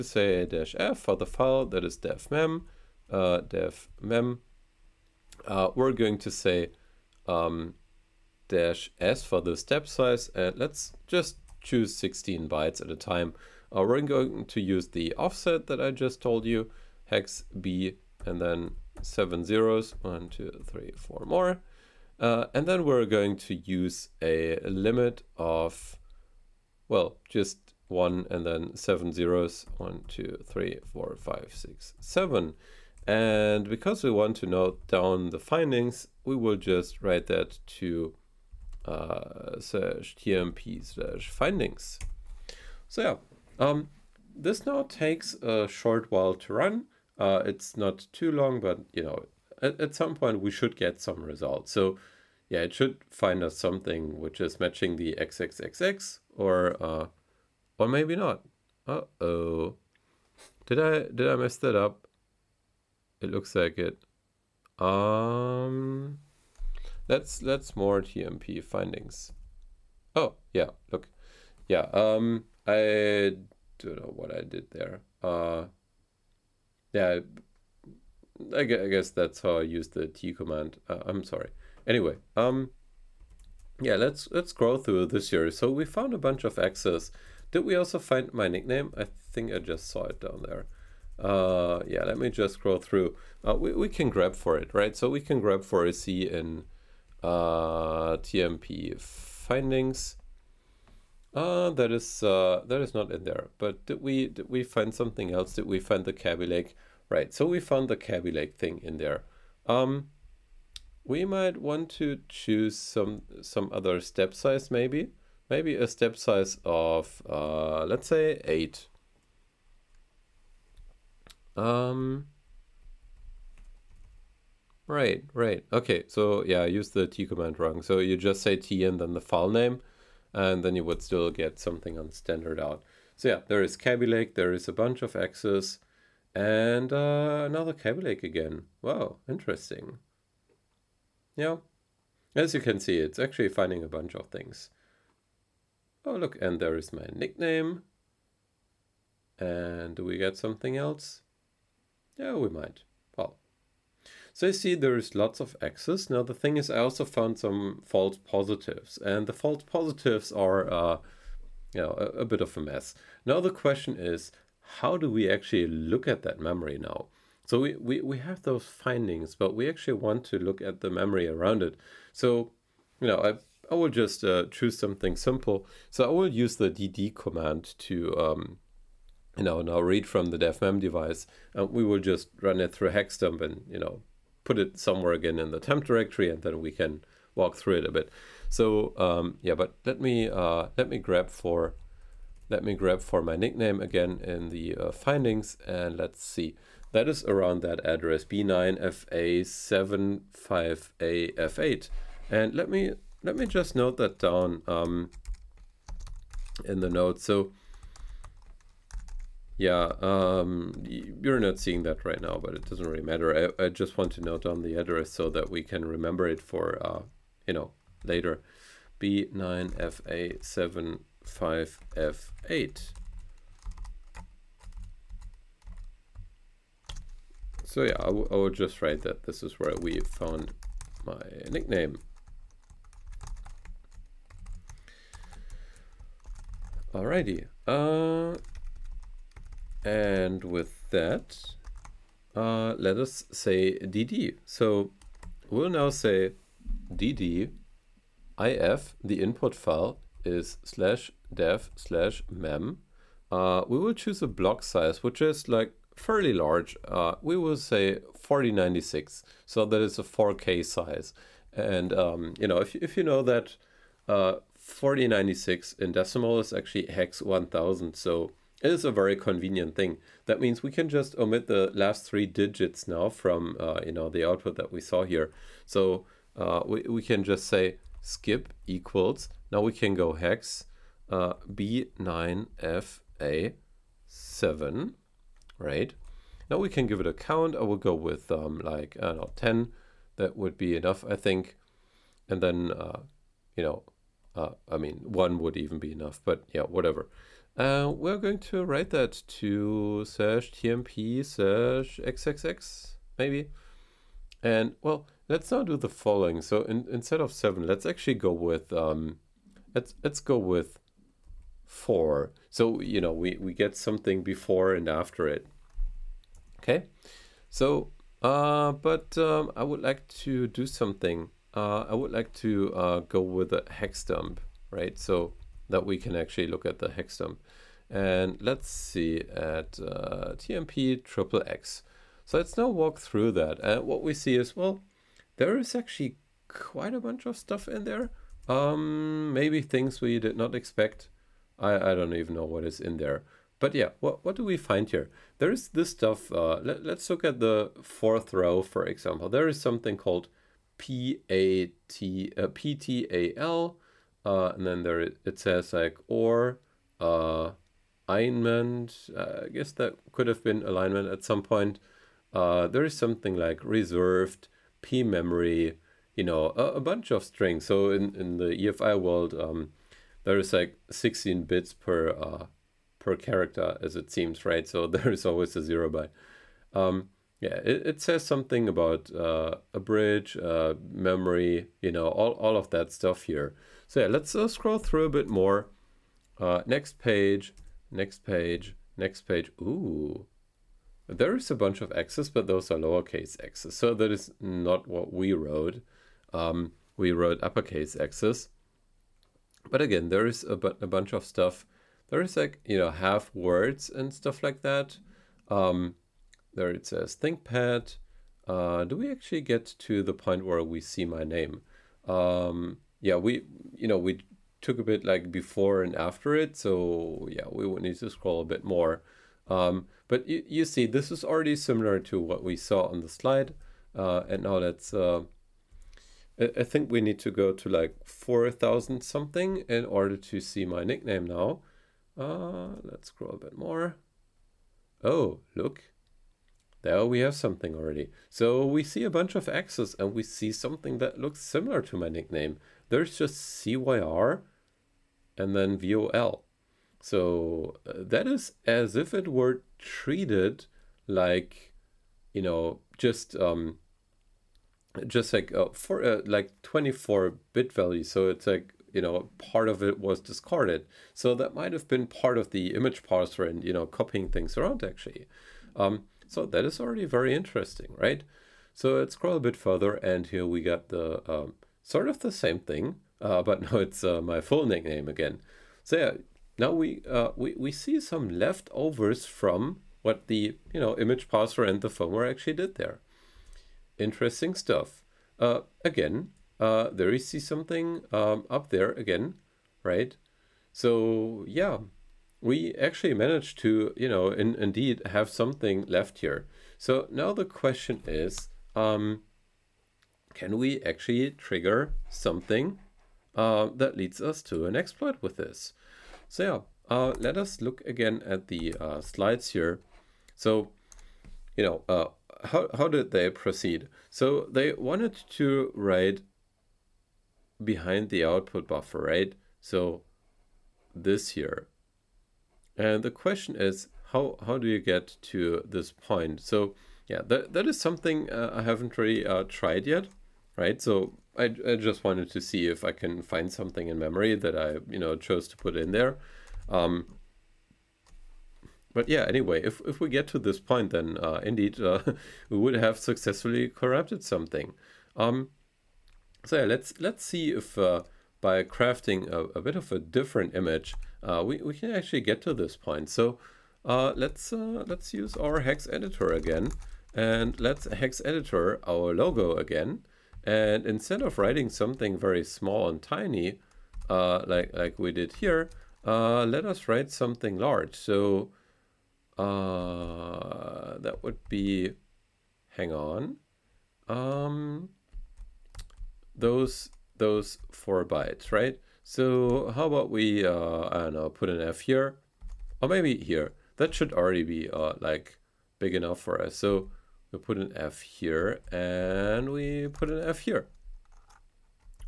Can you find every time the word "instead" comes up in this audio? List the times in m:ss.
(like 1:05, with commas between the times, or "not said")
5:06, 9:20.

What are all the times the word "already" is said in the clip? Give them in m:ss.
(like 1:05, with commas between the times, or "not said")
7:01, 7:17, 7:46, 9:44.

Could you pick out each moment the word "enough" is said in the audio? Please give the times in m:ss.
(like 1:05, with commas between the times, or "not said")
4:50, 4:55, 9:45.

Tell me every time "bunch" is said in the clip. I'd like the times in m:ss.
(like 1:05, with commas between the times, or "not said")
1:26, 2:14, 2:23, 5:36, 6:06, 6:31, 6:40, 7:19.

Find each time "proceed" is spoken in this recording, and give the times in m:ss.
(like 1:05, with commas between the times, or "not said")
8:33.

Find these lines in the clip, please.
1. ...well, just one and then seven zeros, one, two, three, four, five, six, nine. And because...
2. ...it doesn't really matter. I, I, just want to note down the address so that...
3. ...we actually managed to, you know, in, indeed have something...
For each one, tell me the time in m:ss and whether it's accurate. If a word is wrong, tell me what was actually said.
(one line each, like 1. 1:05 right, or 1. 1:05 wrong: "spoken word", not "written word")
1. 0:26 wrong: "seven", not "nine"
2. 3:32 right
3. 8:12 right.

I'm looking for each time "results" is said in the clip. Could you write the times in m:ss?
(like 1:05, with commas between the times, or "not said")
0:51.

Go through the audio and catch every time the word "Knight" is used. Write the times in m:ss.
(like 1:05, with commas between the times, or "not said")
not said.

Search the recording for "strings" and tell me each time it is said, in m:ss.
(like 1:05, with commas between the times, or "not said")
6:07.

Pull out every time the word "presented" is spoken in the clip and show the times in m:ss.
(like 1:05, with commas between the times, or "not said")
not said.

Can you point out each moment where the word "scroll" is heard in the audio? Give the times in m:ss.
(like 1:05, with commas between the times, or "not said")
1:24, 1:32, 6:24, 6:58, 7:13, 7:49.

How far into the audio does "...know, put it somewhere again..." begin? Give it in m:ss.
3:03.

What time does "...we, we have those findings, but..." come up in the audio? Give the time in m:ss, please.
2:47.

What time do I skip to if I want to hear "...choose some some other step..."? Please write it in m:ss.
1:52.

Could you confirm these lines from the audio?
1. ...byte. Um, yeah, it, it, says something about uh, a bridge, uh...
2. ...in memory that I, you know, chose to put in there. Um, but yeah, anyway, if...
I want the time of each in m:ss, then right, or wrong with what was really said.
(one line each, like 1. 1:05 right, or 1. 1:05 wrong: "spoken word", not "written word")
1. 6:15 right
2. 8:53 right.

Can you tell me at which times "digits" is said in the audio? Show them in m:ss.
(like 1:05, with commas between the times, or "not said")
4:32.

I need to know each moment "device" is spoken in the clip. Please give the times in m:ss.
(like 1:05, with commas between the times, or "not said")
3:00.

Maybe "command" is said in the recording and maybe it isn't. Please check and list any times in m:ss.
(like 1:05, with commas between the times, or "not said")
1:20, 2:07, 2:57.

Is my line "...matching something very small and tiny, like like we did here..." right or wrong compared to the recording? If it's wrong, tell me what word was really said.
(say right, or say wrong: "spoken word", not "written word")
wrong: "writing", not "matching".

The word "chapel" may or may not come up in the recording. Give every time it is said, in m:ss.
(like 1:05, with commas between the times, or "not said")
not said.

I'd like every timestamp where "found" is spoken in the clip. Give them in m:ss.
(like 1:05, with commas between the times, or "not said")
1:25, 1:47, 2:37, 3:49.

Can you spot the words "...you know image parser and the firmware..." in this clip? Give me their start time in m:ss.
8:00.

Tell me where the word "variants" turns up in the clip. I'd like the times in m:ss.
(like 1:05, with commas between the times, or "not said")
not said.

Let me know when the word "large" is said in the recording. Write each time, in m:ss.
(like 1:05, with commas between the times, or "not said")
4:16, 9:27.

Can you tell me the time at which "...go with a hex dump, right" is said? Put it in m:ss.
5:22.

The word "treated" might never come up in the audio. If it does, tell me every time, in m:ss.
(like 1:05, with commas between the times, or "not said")
7:29.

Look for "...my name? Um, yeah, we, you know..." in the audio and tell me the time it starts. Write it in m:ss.
6:51.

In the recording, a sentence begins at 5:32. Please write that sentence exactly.
So let's now walk through that.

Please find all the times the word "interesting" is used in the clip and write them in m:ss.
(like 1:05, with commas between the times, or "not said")
2:19, 7:47, 8:03.